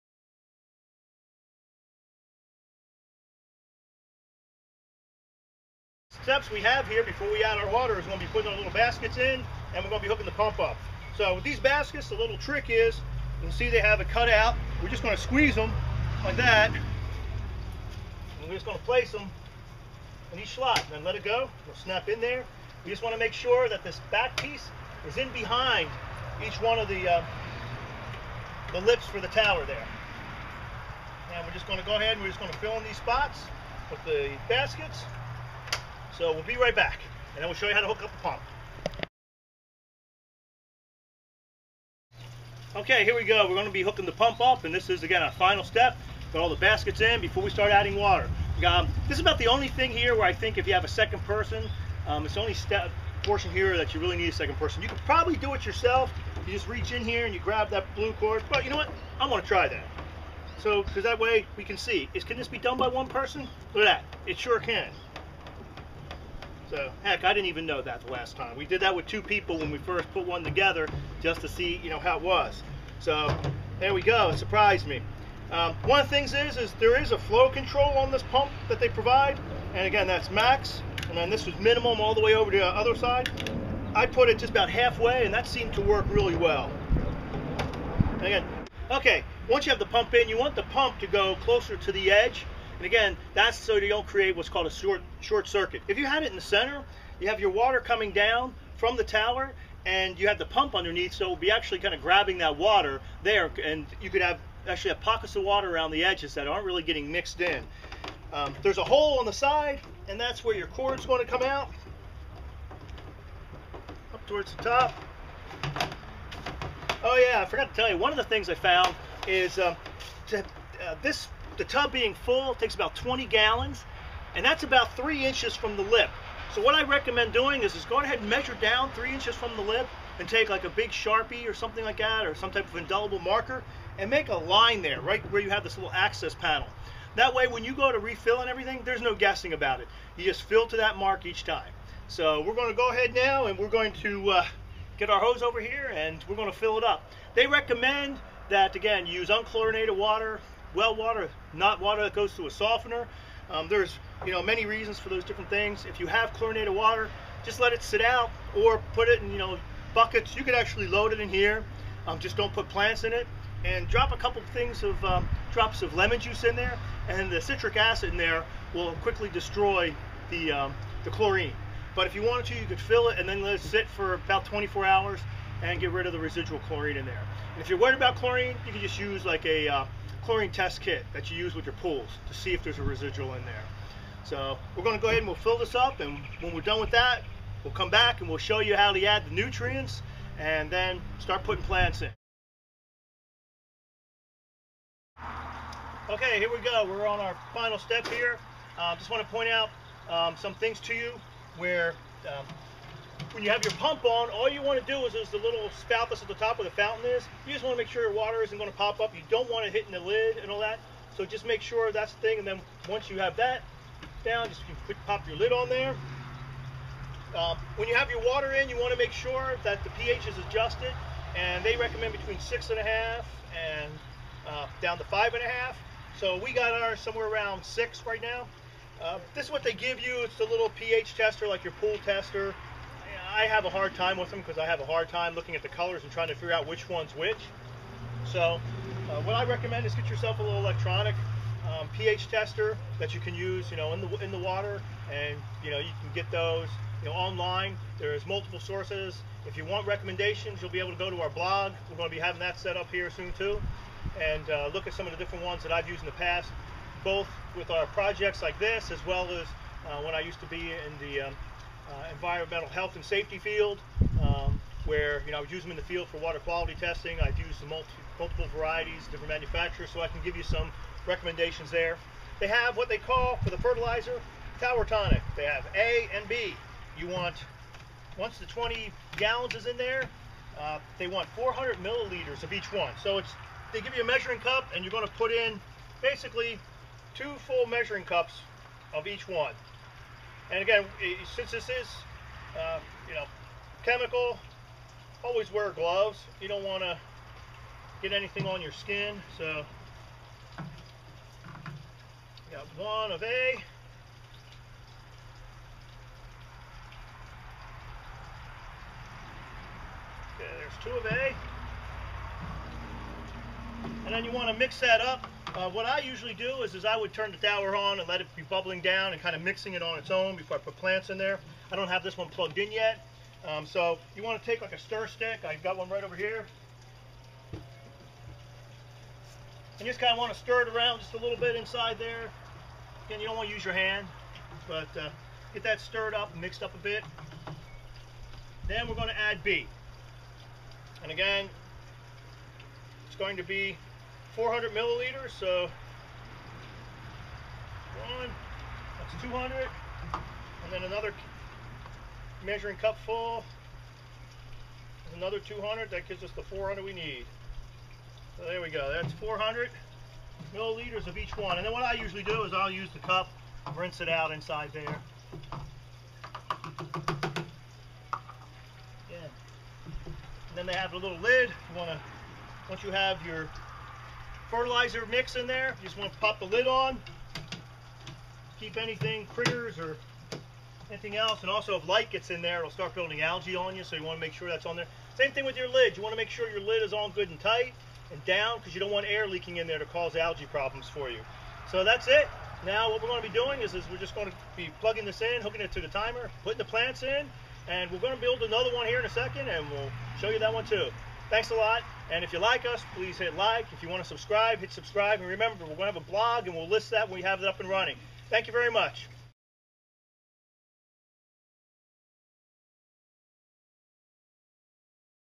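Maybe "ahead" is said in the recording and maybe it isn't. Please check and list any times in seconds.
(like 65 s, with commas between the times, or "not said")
31 s, 127 s, 142 s, 185 s.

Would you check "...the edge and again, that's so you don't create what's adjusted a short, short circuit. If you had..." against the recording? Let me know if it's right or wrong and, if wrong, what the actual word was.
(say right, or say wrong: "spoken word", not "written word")
wrong: "called", not "adjusted".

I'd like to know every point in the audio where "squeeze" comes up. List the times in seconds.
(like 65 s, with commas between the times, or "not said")
15 s.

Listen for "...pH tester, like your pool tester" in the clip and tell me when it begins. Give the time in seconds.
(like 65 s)
230 s.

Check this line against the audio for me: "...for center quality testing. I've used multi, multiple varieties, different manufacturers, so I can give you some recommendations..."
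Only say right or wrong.
wrong.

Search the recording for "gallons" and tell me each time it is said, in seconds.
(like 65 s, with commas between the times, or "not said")
123 s, 279 s.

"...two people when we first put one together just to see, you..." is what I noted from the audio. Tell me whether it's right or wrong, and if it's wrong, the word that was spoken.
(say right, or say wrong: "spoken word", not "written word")
right.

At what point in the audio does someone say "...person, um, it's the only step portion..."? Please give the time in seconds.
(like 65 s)
51 s.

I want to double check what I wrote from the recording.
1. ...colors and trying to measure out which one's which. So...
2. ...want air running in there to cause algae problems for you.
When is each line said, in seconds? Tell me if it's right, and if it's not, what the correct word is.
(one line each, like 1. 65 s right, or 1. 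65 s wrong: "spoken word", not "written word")
1. 235 s wrong: "figure", not "measure"
2. 388 s wrong: "leaking", not "running".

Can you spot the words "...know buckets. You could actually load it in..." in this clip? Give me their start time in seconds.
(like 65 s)
159 s.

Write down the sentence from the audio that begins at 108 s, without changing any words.
Um, there's a hole on the side, and that's where your cord's going to come out, up towards the top.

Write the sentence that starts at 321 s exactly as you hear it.
I don't have this one plugged in yet.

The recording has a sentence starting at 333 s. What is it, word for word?
Again, you don't want to use your hand, but uh, get that stirred up, mixed up a bit.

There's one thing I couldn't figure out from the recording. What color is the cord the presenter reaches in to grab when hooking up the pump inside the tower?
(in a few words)
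blue.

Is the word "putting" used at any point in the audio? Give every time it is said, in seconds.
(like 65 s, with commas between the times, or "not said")
8 s, 191 s, 396 s.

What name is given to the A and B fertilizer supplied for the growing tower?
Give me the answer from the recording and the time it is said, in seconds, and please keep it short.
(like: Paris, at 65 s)
tower tonic, at 274 s.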